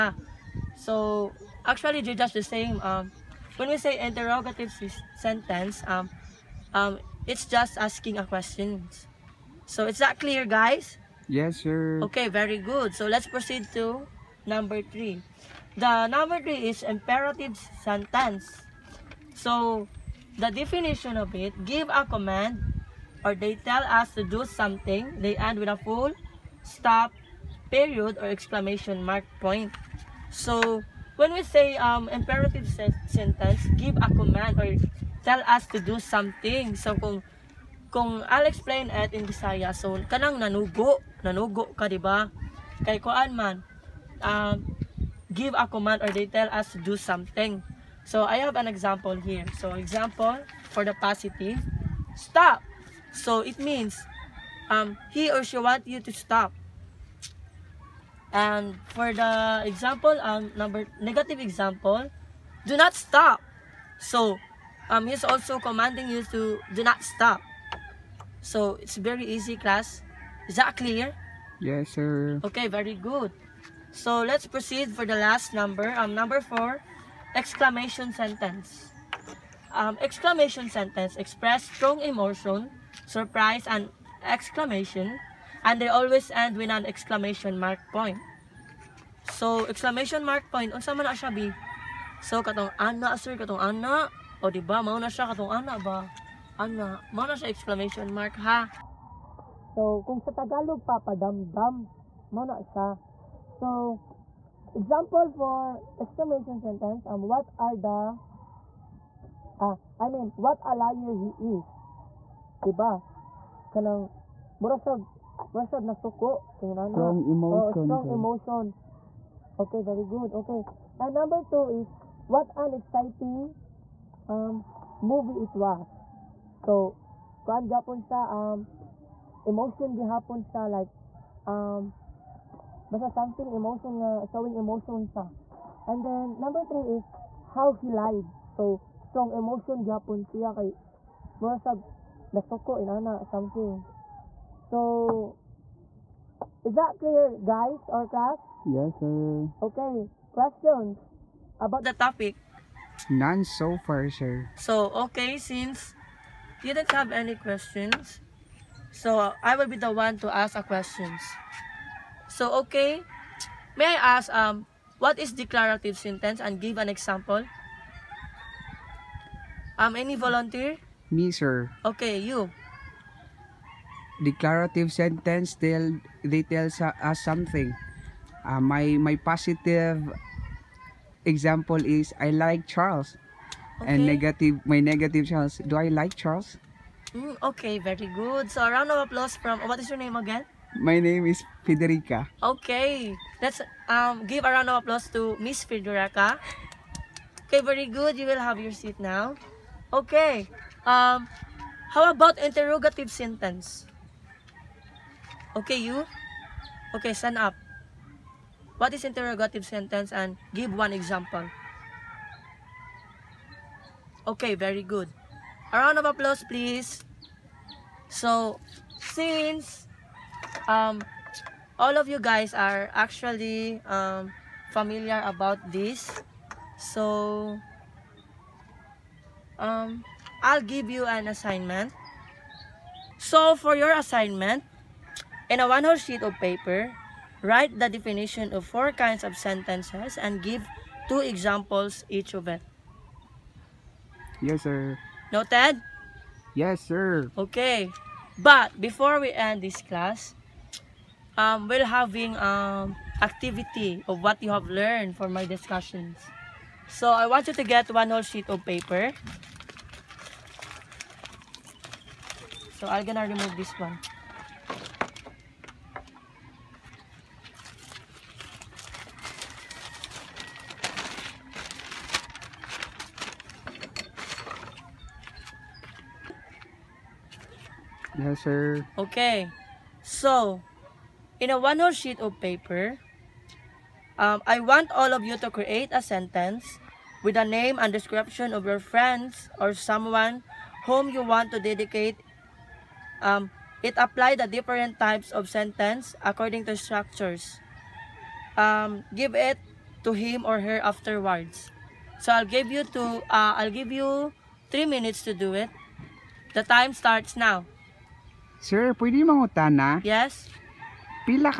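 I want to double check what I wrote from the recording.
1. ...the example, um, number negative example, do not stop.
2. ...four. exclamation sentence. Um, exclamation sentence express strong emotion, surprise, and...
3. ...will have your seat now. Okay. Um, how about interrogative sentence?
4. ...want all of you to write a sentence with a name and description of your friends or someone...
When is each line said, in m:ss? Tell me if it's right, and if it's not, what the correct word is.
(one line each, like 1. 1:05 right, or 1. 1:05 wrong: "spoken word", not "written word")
1. 0:59 right
2. 1:16 right
3. 3:18 right
4. 4:44 wrong: "create", not "write".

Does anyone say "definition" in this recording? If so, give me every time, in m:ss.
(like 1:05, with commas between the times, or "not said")
0:20, 3:57.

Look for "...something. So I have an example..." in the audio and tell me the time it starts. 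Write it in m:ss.
0:46.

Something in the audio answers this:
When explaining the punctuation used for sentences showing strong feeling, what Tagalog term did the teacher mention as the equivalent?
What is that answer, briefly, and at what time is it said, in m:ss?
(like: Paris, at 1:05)
Papadamdam, at 1:40.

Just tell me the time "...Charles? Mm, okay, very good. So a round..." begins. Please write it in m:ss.
3:06.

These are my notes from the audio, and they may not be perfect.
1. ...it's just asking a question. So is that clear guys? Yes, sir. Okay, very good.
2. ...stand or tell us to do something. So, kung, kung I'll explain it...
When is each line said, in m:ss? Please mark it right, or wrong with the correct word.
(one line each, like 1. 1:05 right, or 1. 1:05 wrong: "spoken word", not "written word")
1. 0:07 right
2. 0:34 wrong: "command", not "stand".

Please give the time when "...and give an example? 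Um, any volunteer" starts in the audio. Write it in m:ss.
2:46.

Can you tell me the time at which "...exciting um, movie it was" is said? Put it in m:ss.
2:02.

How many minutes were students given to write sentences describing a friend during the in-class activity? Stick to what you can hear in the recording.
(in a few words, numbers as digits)
3.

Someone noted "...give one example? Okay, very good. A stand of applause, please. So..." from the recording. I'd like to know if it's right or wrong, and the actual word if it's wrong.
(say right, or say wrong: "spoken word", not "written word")
wrong: "round", not "stand".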